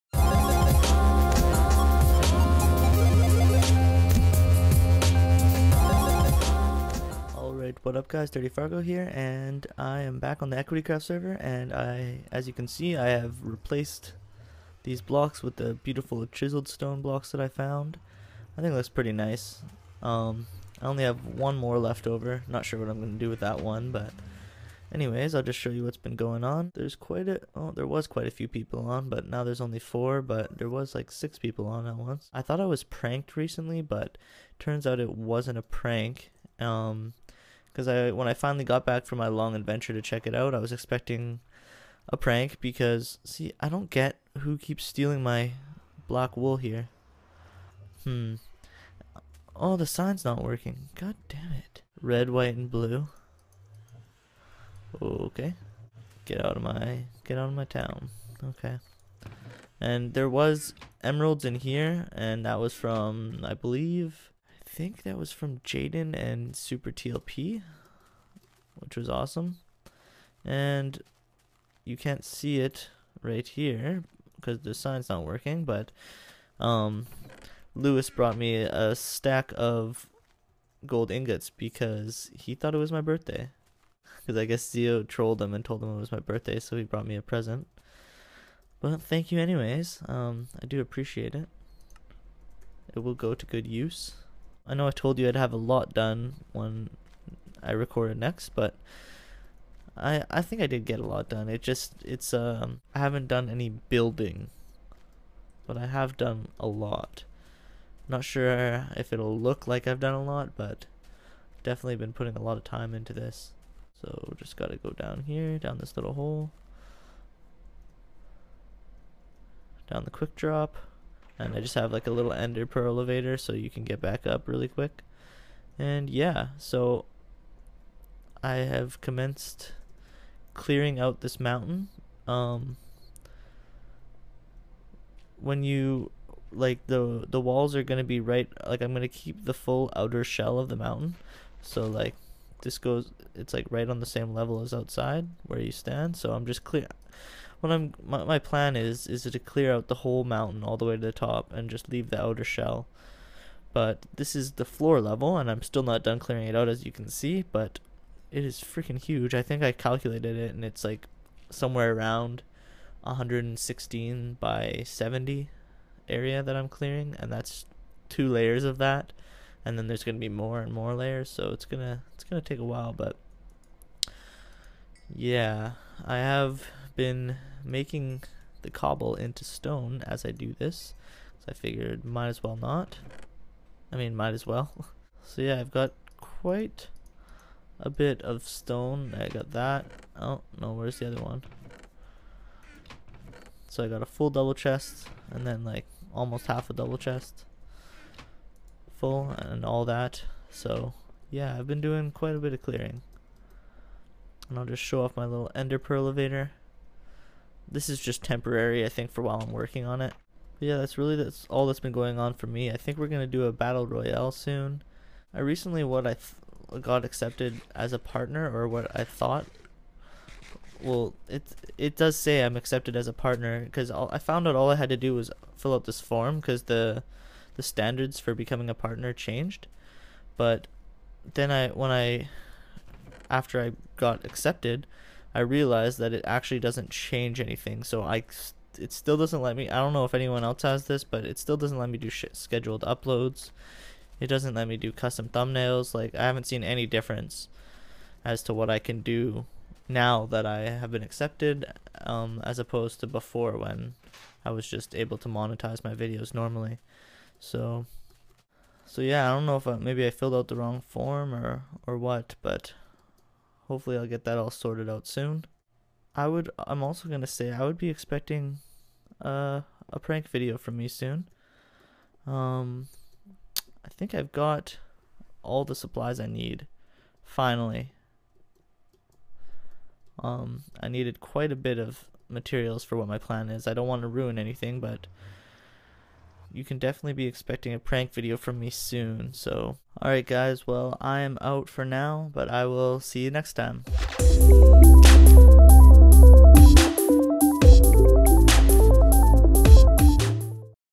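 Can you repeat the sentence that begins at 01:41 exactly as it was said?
It just it's um I haven't done any building, but I have done a lot.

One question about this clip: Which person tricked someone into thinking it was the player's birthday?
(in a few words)
Zio.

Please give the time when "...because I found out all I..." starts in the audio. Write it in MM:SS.
03:43.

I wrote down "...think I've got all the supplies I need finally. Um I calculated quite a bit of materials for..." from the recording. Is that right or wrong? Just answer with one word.
wrong.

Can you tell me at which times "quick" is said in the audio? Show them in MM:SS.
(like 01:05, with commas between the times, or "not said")
02:00, 02:04.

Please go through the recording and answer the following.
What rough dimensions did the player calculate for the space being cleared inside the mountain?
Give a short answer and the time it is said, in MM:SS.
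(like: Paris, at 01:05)
116 by 70, at 02:43.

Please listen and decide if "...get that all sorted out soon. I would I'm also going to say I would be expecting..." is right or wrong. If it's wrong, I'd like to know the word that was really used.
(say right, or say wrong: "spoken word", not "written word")
right.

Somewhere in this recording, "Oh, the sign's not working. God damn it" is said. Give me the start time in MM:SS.
00:49.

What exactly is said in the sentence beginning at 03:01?
So I figured might as well not.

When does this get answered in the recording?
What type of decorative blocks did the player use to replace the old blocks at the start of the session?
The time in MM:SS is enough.
00:16.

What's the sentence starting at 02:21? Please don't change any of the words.
So like this goes it's like right on the same level as outside where you stand.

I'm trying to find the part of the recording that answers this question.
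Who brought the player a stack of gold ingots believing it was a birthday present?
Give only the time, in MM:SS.
01:17.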